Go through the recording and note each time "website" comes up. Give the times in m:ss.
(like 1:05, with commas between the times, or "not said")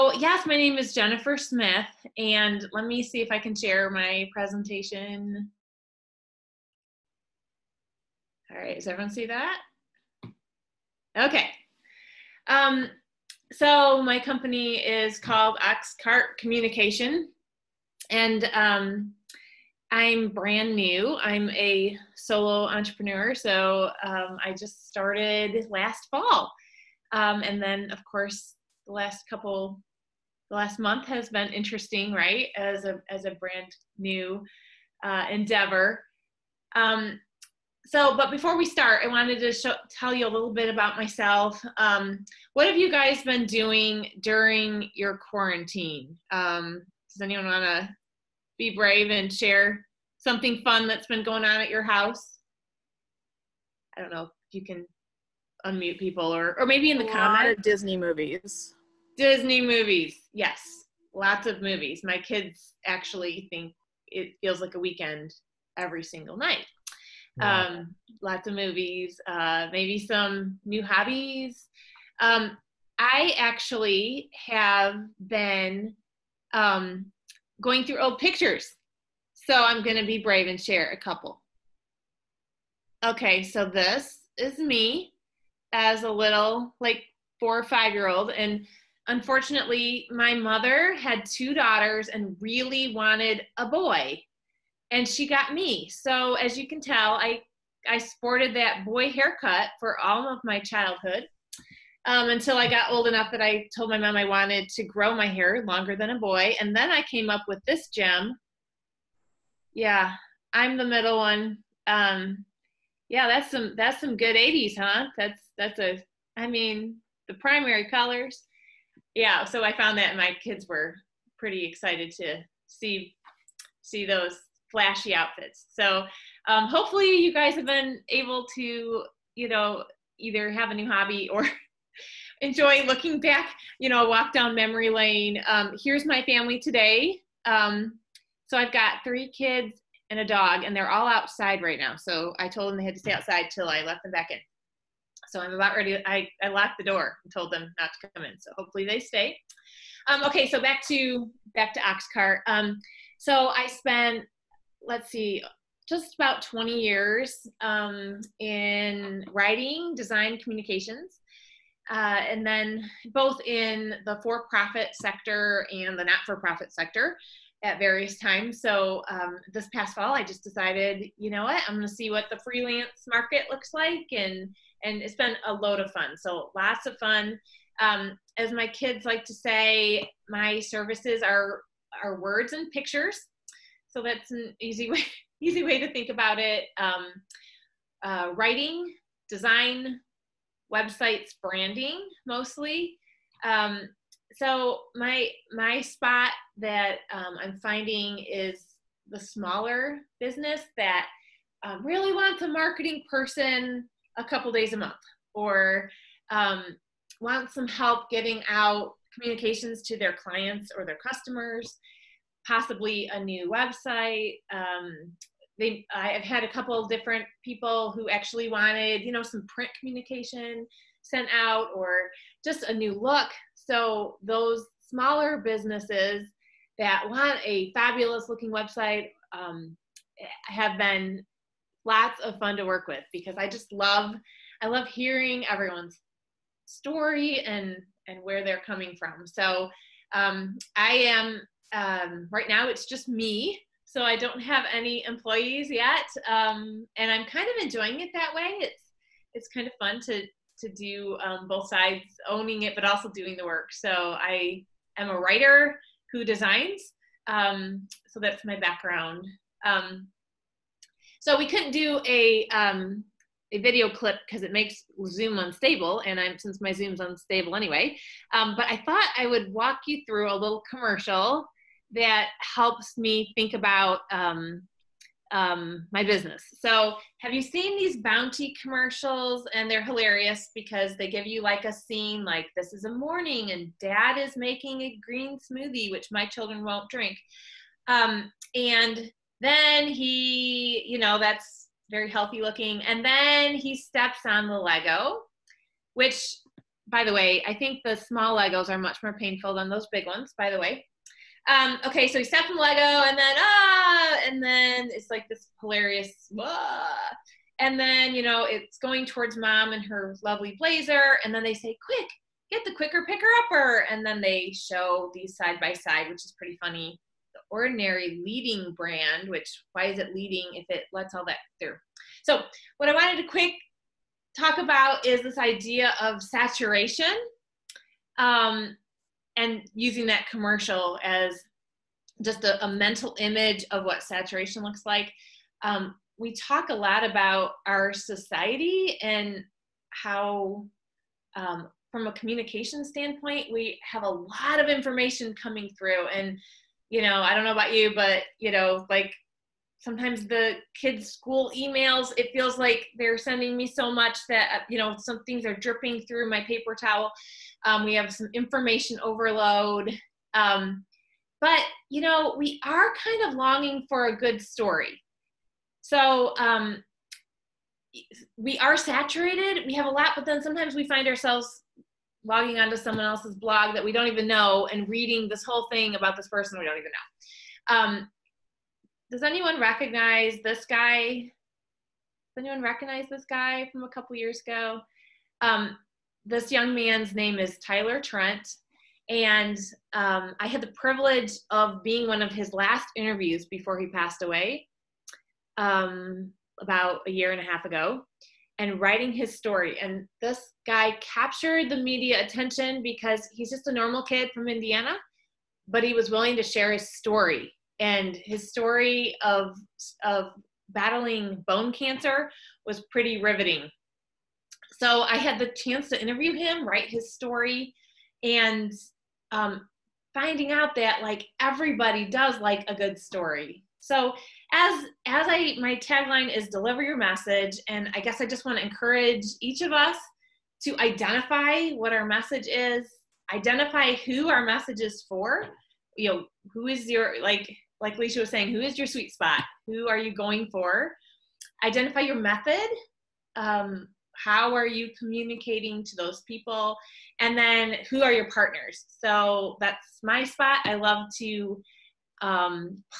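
3:10, 3:33, 3:48.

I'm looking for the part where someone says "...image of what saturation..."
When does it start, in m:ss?
5:33.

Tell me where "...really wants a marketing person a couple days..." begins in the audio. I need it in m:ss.
3:21.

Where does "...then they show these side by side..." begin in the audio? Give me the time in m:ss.
5:14.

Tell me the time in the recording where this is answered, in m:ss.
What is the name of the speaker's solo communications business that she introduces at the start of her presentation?
0:15.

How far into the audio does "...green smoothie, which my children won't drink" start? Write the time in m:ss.
4:45.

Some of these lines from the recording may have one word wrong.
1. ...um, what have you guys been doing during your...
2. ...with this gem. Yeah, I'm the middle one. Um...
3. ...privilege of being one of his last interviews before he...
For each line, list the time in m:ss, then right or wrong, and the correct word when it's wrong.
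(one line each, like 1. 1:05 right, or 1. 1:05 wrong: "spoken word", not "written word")
1. 0:41 right
2. 1:47 right
3. 6:30 right.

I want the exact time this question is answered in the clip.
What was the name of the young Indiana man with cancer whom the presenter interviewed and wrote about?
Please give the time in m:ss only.
6:27.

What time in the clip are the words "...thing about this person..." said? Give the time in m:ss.
6:15.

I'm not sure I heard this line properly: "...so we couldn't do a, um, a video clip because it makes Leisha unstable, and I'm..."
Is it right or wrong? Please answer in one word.
wrong.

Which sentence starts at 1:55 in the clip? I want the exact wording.
That's that's a I mean, the primary colors.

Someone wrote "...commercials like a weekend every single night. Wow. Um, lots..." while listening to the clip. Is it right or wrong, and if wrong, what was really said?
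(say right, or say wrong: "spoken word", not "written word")
wrong: "feels", not "commercials".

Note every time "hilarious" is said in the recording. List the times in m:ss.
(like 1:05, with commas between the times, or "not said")
4:39, 5:05.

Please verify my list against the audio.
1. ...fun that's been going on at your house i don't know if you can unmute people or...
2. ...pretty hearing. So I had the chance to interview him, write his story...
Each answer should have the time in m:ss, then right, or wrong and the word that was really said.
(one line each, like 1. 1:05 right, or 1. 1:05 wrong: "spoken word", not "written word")
1. 0:50 right
2. 6:52 wrong: "riveting", not "hearing".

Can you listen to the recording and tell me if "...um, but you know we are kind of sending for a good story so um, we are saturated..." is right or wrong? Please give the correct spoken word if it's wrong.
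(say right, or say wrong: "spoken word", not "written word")
wrong: "longing", not "sending".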